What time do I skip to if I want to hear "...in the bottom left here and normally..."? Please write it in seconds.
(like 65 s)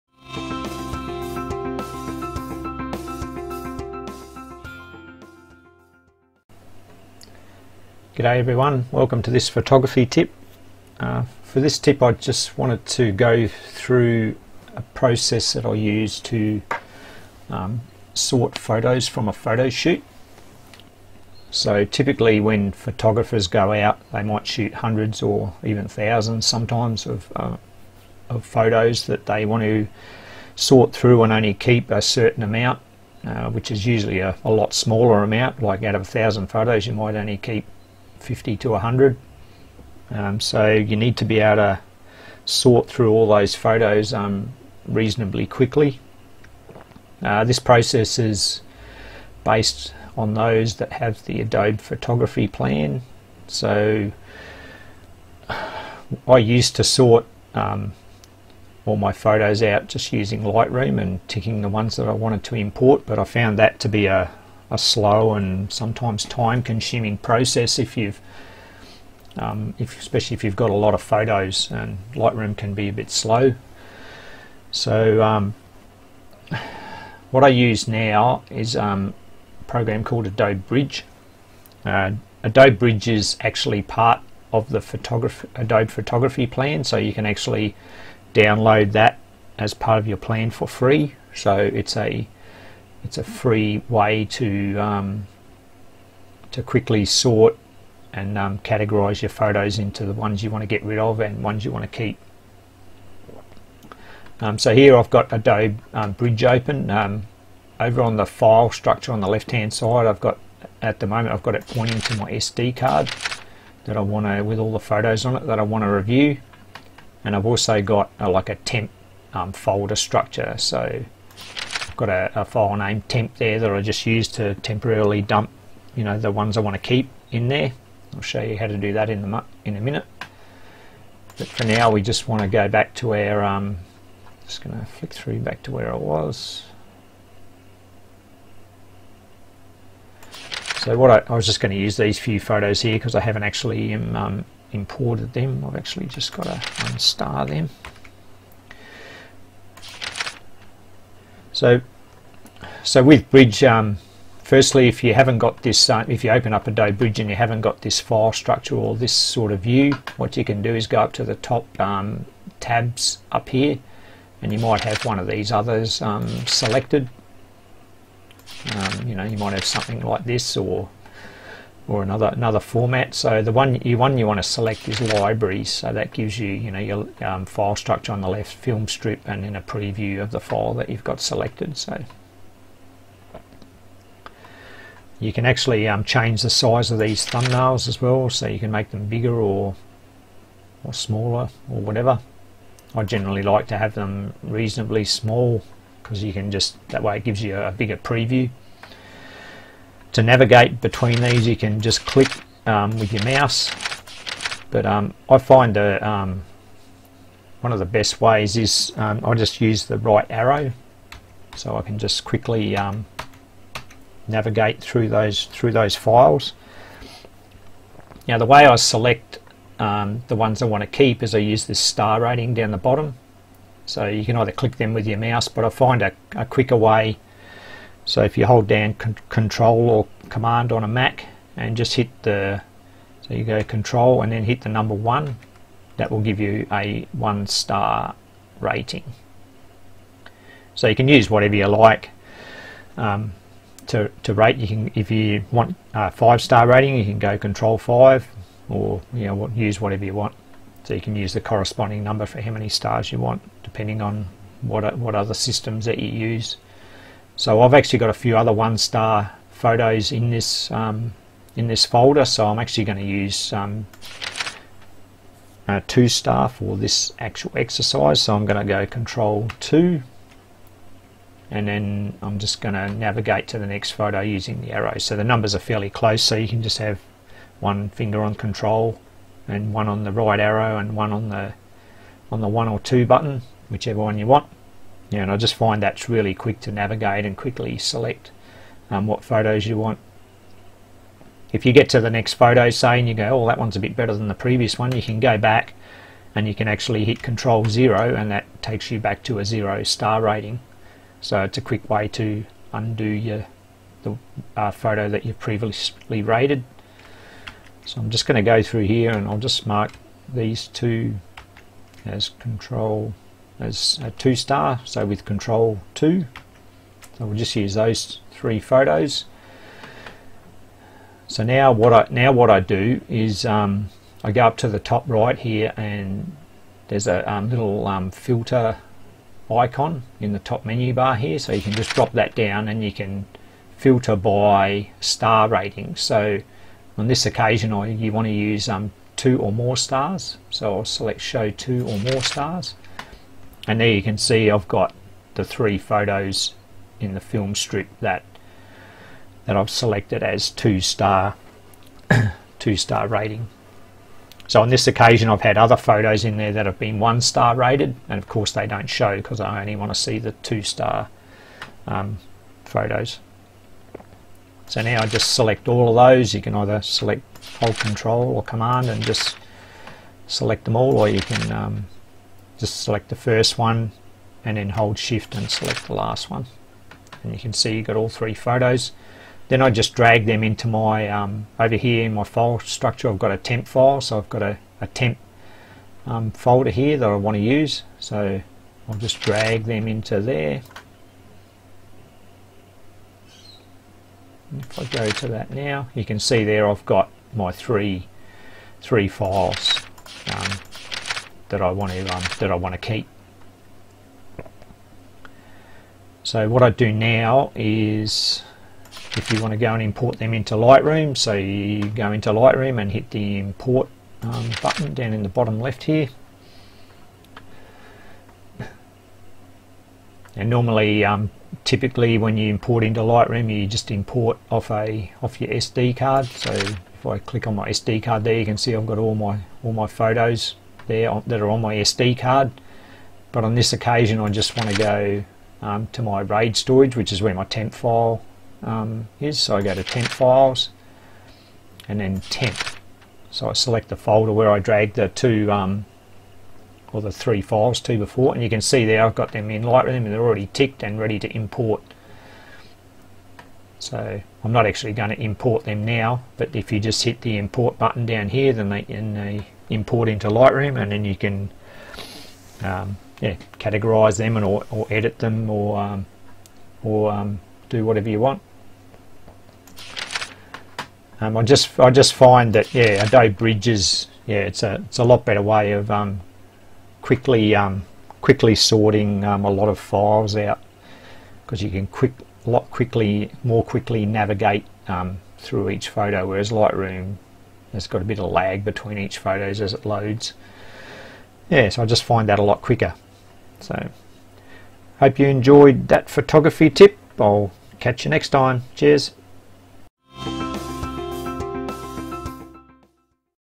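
415 s.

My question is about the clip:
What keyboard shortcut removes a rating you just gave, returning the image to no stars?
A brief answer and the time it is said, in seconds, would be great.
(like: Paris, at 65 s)
Control Zero, at 297 s.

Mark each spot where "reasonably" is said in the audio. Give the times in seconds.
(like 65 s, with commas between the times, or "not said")
44 s, 194 s.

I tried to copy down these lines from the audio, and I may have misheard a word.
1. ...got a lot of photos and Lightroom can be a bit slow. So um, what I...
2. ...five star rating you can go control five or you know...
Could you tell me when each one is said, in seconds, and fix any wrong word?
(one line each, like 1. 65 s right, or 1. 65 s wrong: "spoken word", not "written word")
1. 70 s right
2. 246 s right.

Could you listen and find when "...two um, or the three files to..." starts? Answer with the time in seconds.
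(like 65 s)
445 s.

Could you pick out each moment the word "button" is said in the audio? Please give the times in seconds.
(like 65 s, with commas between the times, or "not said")
283 s, 414 s, 457 s.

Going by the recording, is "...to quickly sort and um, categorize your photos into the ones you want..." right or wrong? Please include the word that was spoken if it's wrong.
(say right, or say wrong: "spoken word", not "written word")
right.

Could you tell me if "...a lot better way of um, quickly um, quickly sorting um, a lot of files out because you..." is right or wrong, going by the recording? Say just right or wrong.
right.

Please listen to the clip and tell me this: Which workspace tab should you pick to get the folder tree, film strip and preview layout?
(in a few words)
libraries.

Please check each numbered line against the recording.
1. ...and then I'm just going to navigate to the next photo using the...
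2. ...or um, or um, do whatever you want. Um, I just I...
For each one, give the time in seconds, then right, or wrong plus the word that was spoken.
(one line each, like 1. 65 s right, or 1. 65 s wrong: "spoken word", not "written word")
1. 271 s right
2. 465 s right.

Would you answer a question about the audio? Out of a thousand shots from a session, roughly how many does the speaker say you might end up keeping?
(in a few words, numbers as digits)
50 to 100.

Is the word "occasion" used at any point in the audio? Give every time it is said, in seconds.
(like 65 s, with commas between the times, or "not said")
337 s, 354 s, 433 s.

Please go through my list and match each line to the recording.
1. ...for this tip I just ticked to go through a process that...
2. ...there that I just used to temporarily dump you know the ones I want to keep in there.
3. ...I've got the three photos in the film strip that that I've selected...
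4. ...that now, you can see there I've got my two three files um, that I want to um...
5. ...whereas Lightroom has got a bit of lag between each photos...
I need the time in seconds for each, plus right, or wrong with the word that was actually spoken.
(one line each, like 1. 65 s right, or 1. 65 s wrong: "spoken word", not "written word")
1. 11 s wrong: "wanted", not "ticked"
2. 123 s right
3. 344 s right
4. 395 s wrong: "three", not "two"
5. 486 s right.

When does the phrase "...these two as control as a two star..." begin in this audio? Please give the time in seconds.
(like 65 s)
310 s.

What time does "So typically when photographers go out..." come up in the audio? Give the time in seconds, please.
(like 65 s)
21 s.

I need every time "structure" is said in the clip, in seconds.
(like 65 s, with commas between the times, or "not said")
108 s, 119 s, 158 s, 177 s, 382 s.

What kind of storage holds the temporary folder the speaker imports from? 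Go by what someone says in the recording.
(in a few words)
RAID storage.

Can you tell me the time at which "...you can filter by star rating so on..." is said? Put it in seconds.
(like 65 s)
332 s.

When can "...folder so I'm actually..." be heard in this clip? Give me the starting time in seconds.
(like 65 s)
261 s.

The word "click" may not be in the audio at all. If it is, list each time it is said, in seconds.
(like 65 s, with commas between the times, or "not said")
202 s, 224 s, 427 s.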